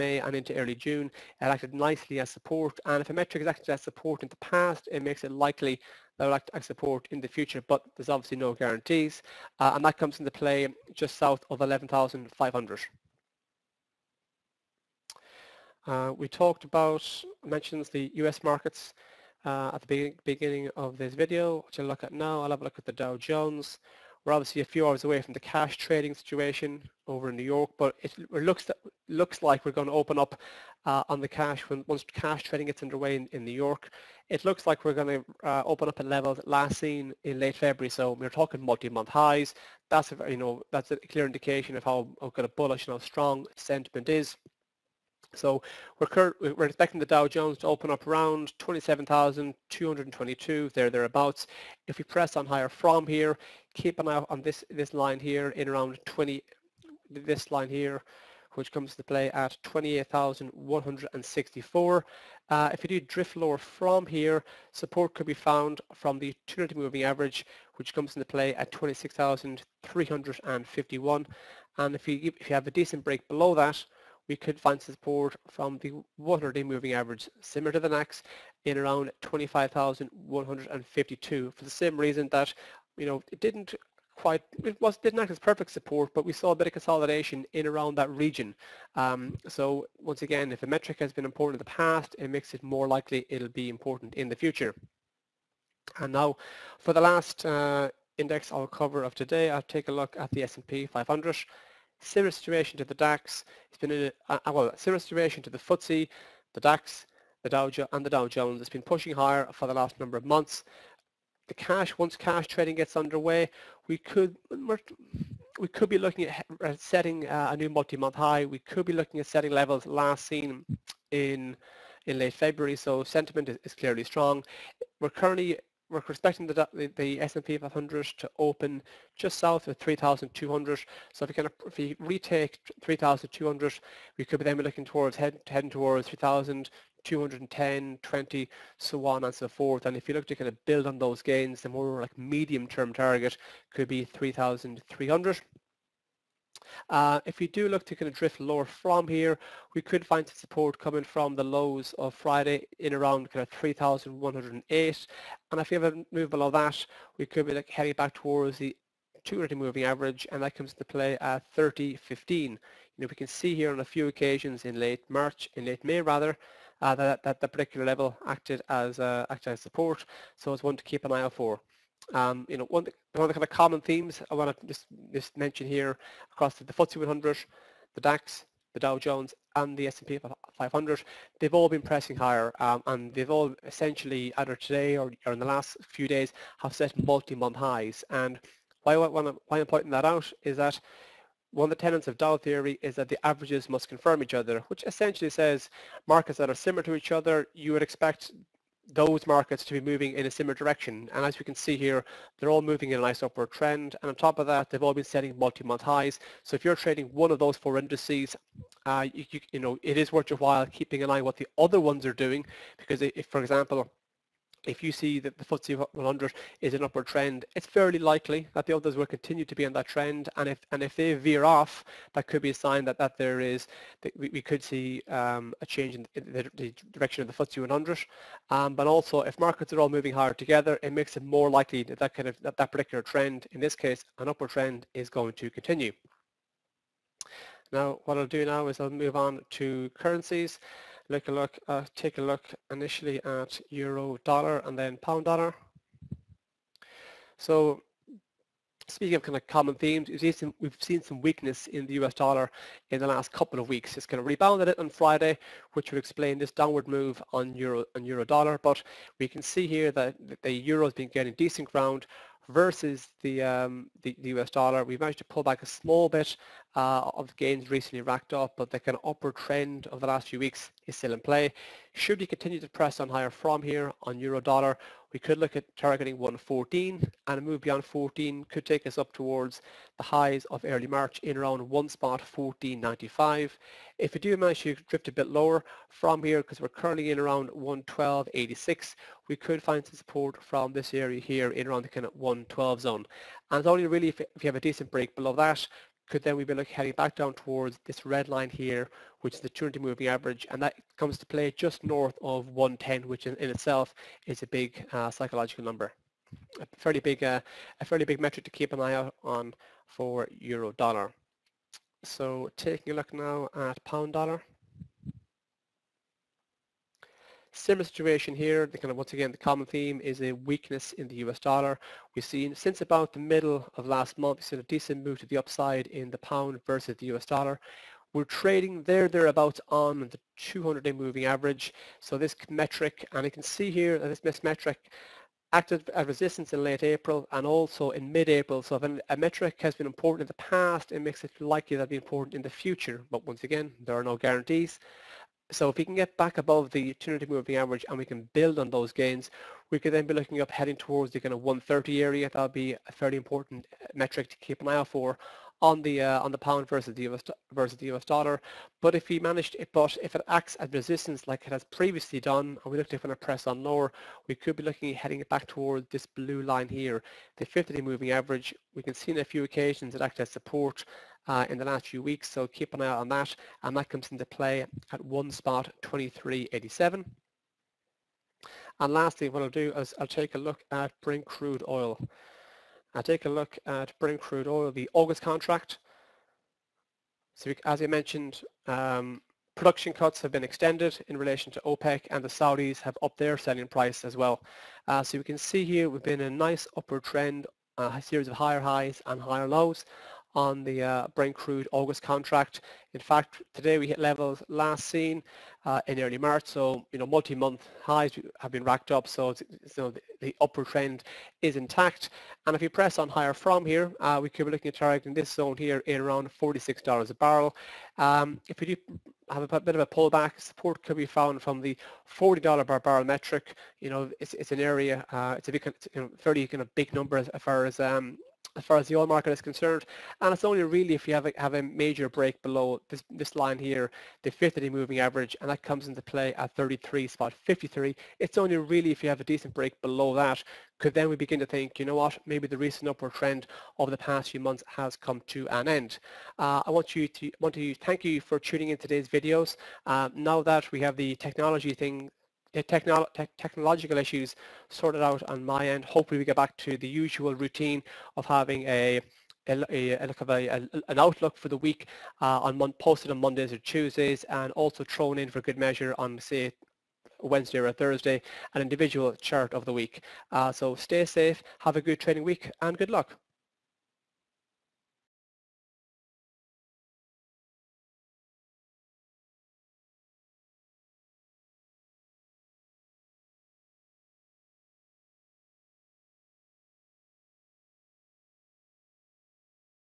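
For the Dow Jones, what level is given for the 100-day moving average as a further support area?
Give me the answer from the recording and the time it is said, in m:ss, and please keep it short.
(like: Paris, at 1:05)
25,152, at 1:19.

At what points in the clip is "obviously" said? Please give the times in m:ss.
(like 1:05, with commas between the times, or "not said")
0:08, 0:24.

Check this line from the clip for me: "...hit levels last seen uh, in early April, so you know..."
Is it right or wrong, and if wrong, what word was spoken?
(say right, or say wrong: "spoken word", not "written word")
wrong: "March", not "April".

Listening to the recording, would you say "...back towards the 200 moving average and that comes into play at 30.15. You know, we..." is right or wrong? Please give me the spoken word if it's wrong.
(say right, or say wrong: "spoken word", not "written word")
right.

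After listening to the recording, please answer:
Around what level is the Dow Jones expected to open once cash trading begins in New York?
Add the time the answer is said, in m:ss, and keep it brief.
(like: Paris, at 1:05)
27,222, at 0:48.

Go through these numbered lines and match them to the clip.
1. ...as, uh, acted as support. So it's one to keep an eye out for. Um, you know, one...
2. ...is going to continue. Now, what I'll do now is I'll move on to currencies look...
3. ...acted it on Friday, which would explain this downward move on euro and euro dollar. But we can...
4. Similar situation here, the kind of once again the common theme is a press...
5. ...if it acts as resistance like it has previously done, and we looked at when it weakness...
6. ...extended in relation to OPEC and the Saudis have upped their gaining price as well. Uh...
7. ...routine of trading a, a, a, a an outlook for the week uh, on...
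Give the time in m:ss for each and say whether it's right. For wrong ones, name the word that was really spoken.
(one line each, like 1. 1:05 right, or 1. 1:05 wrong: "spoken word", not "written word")
1. 2:48 right
2. 3:54 right
3. 4:14 wrong: "rebounded", not "acted"
4. 5:17 wrong: "weakness", not "press"
5. 6:00 wrong: "press", not "weakness"
6. 6:30 wrong: "selling", not "gaining"
7. 7:37 wrong: "having", not "trading".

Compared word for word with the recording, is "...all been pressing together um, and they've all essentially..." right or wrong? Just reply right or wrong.
wrong.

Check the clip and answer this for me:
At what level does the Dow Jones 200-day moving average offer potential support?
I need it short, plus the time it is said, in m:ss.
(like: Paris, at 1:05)
26,351, at 1:08.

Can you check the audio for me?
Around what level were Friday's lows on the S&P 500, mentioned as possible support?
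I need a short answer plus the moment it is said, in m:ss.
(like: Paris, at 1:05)
3,108, at 2:33.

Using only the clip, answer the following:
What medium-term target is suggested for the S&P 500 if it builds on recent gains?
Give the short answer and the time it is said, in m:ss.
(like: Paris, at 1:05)
3,300, at 2:24.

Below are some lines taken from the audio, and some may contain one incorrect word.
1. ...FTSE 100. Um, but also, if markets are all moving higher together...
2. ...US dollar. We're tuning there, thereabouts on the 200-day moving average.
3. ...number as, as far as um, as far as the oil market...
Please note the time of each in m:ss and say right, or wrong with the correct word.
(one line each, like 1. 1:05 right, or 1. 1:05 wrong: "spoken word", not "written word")
1. 3:47 right
2. 5:27 wrong: "trading", not "tuning"
3. 7:06 right.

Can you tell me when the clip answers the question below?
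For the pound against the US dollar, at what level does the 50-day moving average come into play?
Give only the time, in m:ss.
6:15.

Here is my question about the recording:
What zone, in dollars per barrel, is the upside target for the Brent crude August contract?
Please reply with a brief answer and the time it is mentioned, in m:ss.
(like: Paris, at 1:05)
$46 a barrel, at 6:56.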